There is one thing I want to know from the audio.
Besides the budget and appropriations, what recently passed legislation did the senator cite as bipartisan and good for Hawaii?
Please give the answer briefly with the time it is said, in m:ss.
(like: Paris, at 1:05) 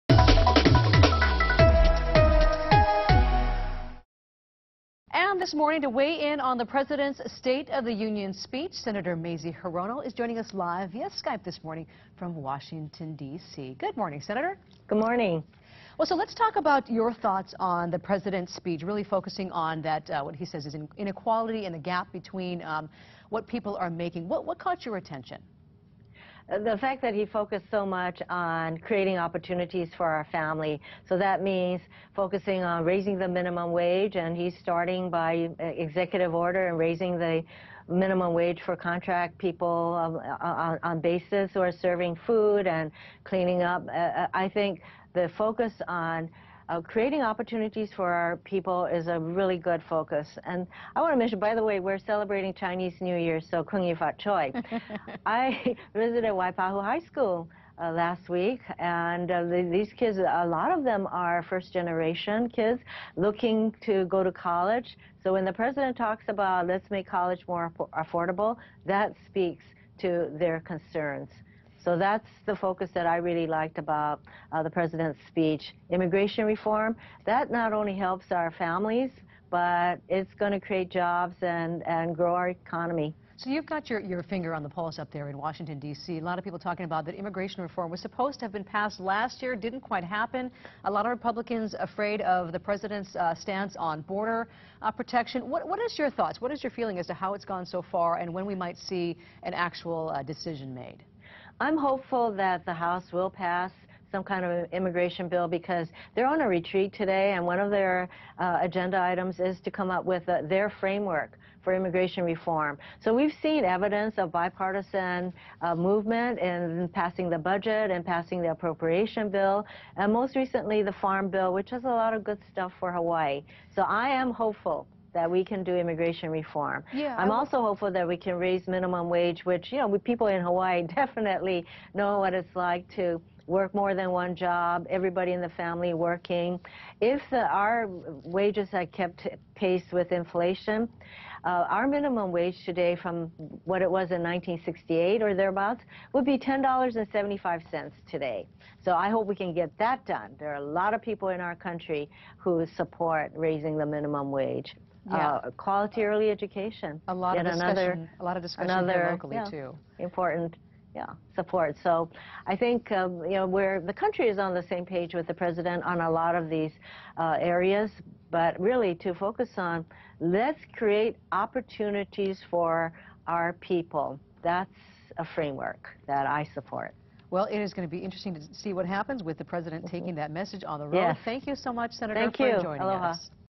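farm bill, at 2:00.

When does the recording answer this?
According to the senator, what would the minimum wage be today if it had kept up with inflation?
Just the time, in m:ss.
2:26.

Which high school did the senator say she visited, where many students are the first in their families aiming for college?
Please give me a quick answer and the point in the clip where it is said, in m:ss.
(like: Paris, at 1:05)
Waipahu High School, at 0:56.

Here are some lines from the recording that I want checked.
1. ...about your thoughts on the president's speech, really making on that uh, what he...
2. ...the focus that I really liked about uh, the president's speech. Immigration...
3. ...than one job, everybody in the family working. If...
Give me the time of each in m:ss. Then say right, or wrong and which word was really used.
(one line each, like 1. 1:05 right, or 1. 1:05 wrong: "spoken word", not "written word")
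1. 0:16 wrong: "focusing", not "making"
2. 1:12 right
3. 2:13 right.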